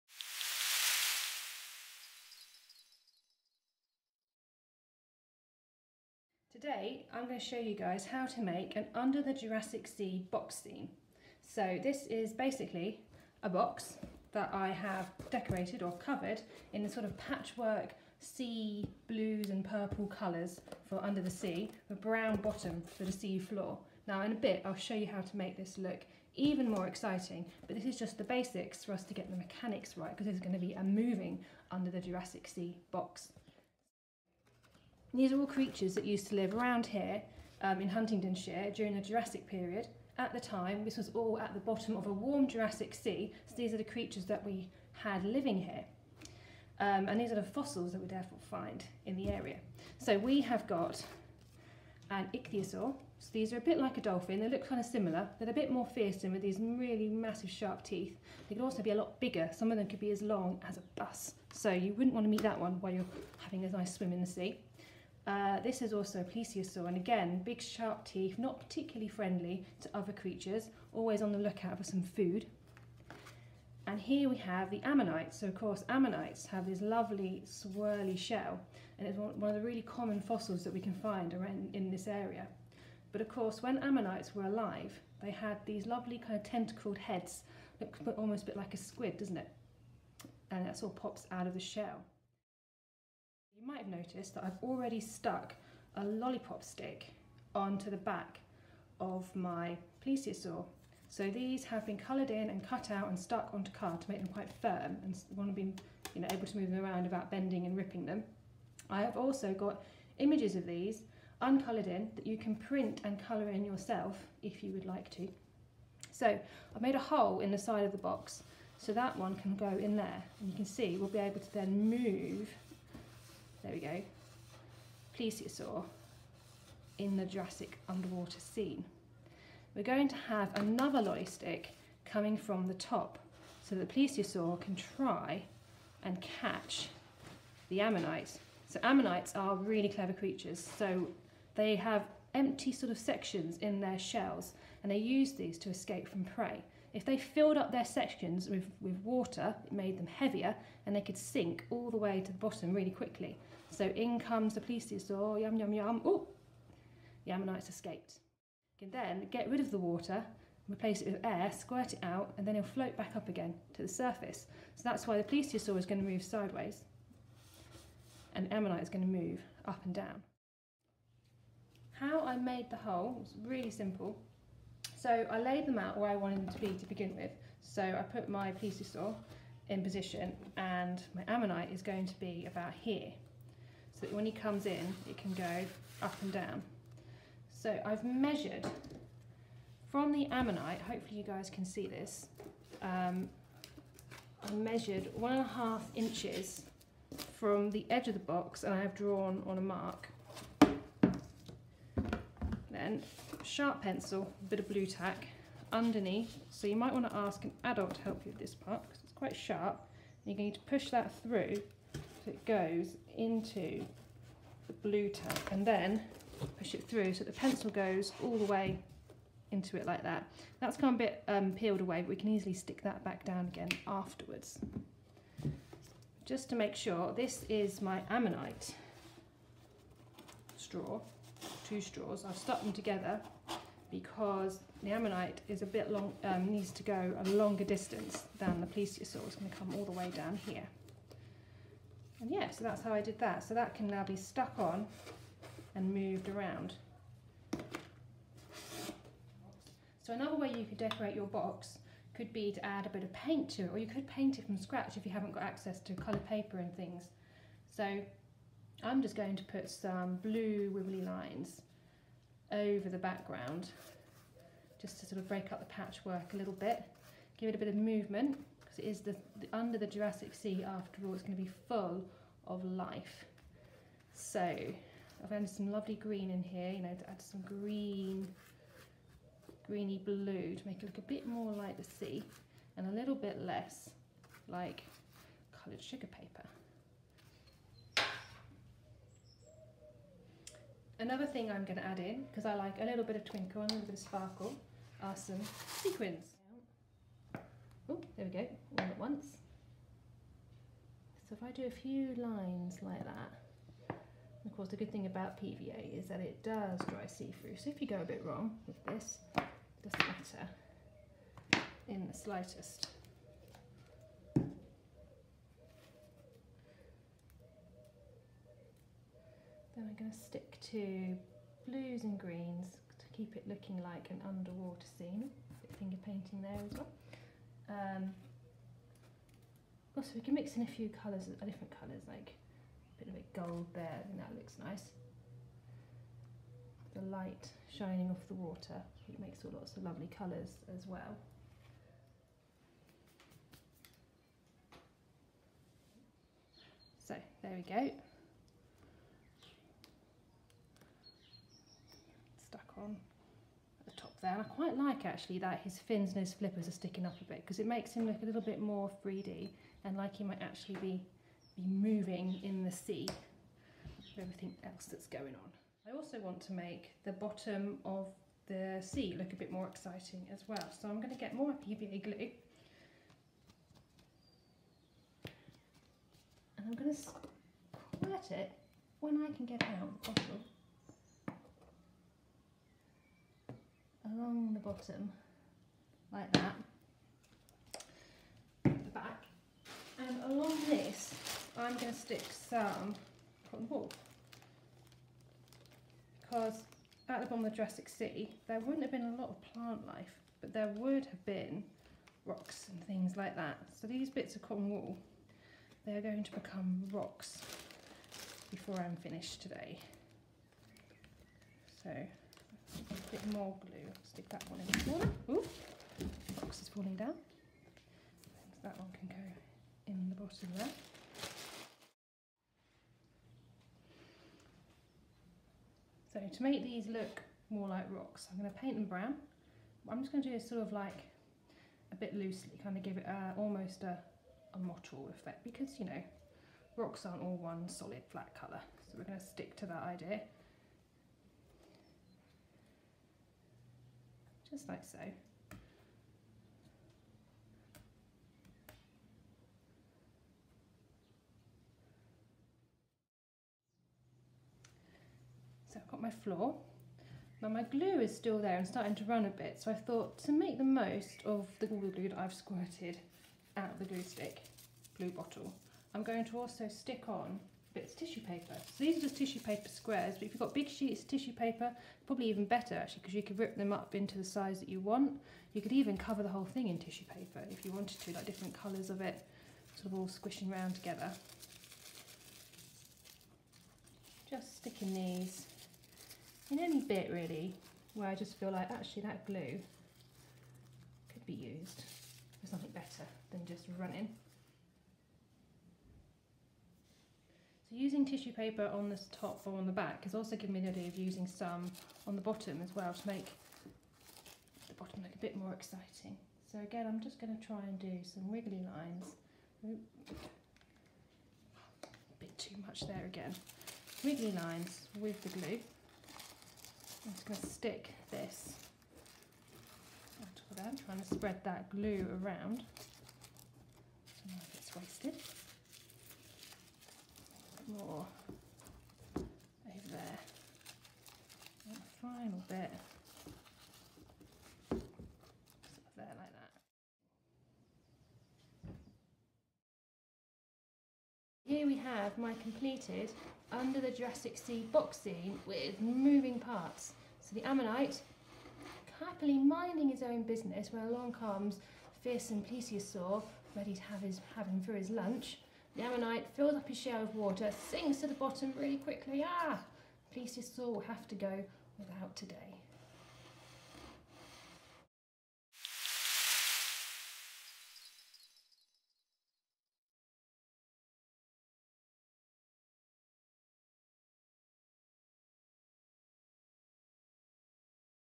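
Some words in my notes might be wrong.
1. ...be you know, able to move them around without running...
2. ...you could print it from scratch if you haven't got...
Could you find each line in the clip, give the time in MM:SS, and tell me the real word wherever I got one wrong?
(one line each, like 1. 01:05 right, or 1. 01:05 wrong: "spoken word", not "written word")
1. 01:45 wrong: "bending", not "running"
2. 04:13 wrong: "paint", not "print".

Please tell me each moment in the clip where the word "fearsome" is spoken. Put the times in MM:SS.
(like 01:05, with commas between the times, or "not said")
00:55, 09:12.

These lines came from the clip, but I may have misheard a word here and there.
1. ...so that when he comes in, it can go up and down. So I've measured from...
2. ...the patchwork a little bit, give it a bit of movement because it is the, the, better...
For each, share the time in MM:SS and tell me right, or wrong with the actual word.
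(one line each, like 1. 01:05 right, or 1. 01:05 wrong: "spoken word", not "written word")
1. 03:04 right
2. 04:25 wrong: "under", not "better".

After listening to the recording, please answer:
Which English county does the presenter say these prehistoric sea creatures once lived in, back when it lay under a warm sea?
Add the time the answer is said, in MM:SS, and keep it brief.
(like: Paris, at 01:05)
Huntingdonshire, at 00:37.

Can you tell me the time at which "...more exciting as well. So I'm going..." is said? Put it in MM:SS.
06:09.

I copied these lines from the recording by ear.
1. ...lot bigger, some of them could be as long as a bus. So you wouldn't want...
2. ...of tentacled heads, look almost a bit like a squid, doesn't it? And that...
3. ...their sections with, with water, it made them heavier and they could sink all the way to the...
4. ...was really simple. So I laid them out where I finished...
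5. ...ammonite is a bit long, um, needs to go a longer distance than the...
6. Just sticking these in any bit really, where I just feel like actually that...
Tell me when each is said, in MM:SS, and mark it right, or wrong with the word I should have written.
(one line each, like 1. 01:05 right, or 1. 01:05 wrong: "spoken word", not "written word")
1. 00:58 right
2. 01:26 right
3. 02:27 right
4. 02:53 wrong: "wanted", not "finished"
5. 03:54 right
6. 08:04 right.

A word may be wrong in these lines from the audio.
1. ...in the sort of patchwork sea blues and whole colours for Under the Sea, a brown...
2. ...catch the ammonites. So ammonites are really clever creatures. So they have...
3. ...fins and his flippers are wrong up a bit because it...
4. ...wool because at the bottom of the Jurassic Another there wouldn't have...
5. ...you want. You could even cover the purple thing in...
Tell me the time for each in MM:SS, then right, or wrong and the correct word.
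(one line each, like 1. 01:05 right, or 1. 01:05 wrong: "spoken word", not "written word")
1. 00:16 wrong: "purple", not "whole"
2. 02:16 right
3. 05:55 wrong: "sticking", not "wrong"
4. 06:33 wrong: "Sea", not "Another"
5. 07:54 wrong: "whole", not "purple".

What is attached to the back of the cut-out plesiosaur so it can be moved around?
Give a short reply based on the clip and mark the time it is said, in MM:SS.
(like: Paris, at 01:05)
A lollipop stick, at 01:36.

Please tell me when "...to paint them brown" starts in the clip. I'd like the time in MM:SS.
07:08.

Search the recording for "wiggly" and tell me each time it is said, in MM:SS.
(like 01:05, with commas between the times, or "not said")
08:28, 08:34.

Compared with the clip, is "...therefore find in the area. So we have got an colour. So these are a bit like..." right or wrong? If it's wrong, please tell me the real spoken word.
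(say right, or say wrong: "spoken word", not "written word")
wrong: "ichthyosaur", not "colour".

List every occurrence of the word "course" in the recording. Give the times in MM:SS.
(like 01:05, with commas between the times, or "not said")
01:15, 01:23, 05:04.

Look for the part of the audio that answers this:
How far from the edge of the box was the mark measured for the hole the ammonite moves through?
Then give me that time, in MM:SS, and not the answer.
03:15.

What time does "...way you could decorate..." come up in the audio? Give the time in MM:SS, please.
04:10.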